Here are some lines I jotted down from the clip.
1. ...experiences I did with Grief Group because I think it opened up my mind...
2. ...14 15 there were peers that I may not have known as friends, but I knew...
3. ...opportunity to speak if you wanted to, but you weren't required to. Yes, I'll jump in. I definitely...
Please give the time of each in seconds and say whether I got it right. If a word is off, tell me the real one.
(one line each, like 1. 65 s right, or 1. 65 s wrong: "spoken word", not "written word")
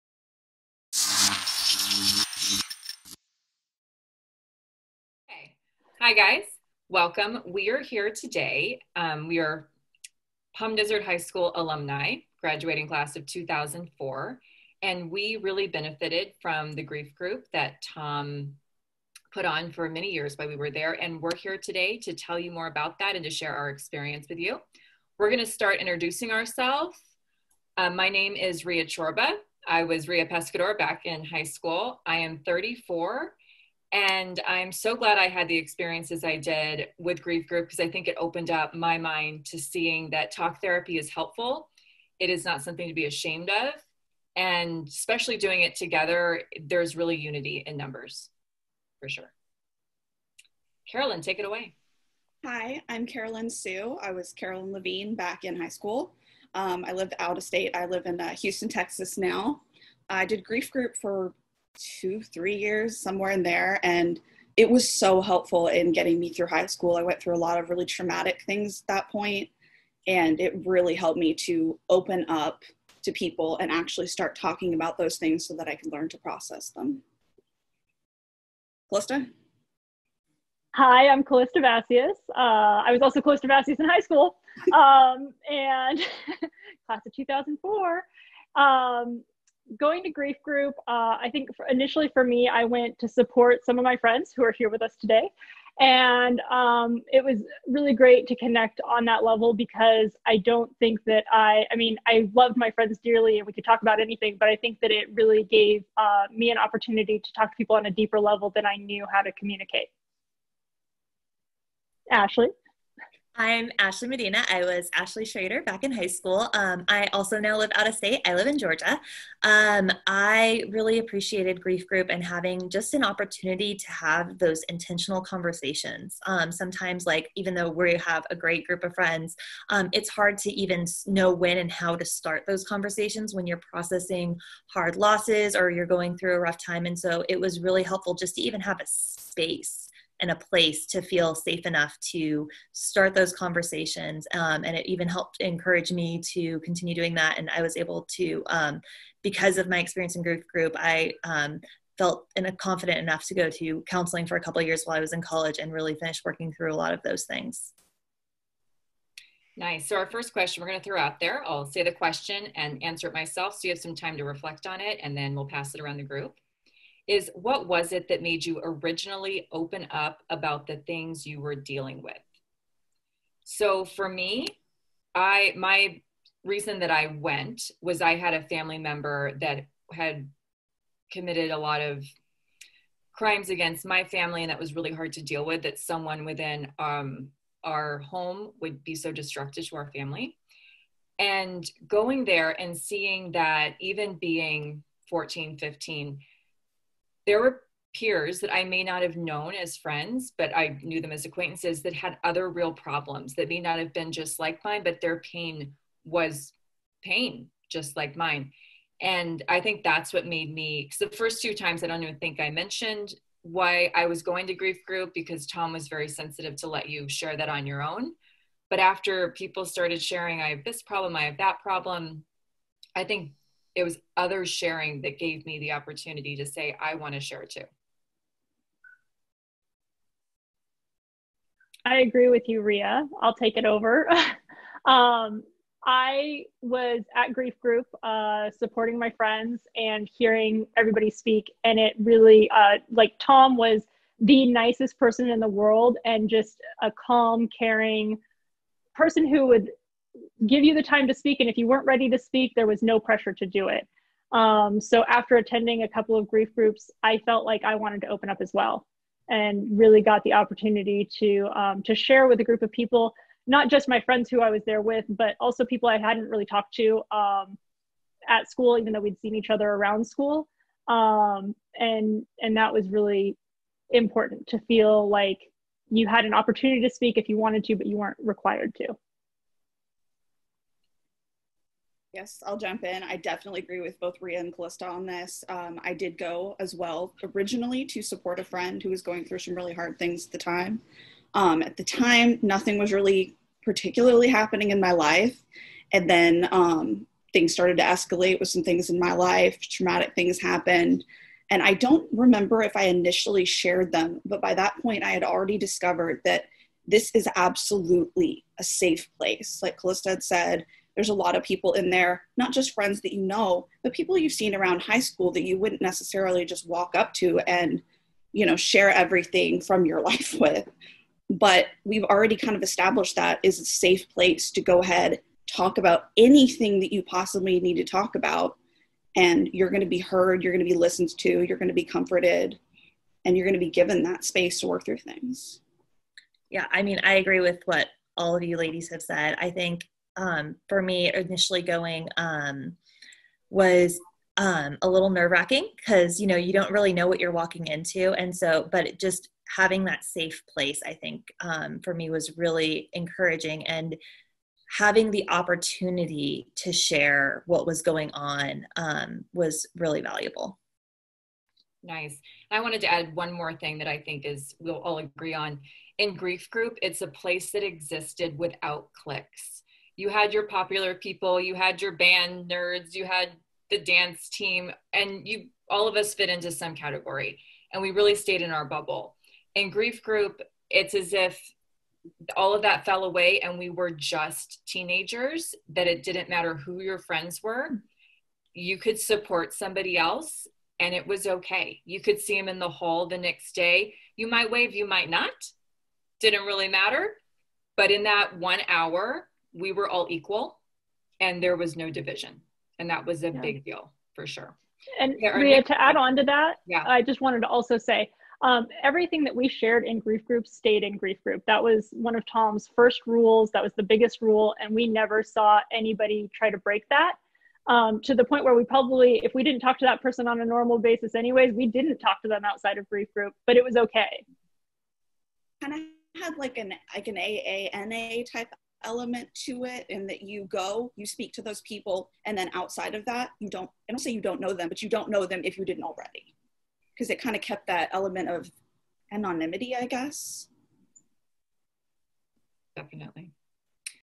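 1. 35 s right
2. 195 s right
3. 276 s right.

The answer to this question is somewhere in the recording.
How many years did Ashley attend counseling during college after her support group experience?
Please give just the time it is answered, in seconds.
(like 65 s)
154 s.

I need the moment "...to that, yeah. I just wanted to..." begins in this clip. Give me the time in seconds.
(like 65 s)
406 s.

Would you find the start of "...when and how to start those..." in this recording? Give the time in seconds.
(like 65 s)
131 s.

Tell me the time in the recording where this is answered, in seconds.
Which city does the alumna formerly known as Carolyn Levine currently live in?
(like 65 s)
58 s.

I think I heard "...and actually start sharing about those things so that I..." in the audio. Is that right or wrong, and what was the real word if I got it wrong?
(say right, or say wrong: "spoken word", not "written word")
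wrong: "talking", not "sharing".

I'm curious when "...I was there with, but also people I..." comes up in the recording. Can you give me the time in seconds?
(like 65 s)
264 s.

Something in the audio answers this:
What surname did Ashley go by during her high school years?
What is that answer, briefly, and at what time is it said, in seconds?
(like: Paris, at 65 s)
Schrader, at 115 s.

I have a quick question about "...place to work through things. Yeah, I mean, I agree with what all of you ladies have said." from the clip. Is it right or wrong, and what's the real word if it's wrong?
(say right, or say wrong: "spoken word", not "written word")
wrong: "space", not "place".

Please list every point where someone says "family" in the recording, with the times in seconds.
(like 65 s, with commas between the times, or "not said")
178 s, 184 s, 189 s.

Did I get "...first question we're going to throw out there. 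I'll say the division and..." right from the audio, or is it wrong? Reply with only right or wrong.
wrong.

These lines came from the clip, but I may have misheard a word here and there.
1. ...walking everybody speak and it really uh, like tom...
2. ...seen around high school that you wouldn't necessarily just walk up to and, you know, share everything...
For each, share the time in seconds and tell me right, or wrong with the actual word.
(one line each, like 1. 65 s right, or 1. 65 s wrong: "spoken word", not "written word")
1. 240 s wrong: "hearing", not "walking"
2. 314 s right.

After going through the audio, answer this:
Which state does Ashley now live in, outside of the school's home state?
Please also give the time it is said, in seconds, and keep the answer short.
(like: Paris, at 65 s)
Georgia, at 118 s.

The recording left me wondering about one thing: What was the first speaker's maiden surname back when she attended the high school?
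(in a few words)
Pescador.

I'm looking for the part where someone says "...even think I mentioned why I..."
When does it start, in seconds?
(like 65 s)
212 s.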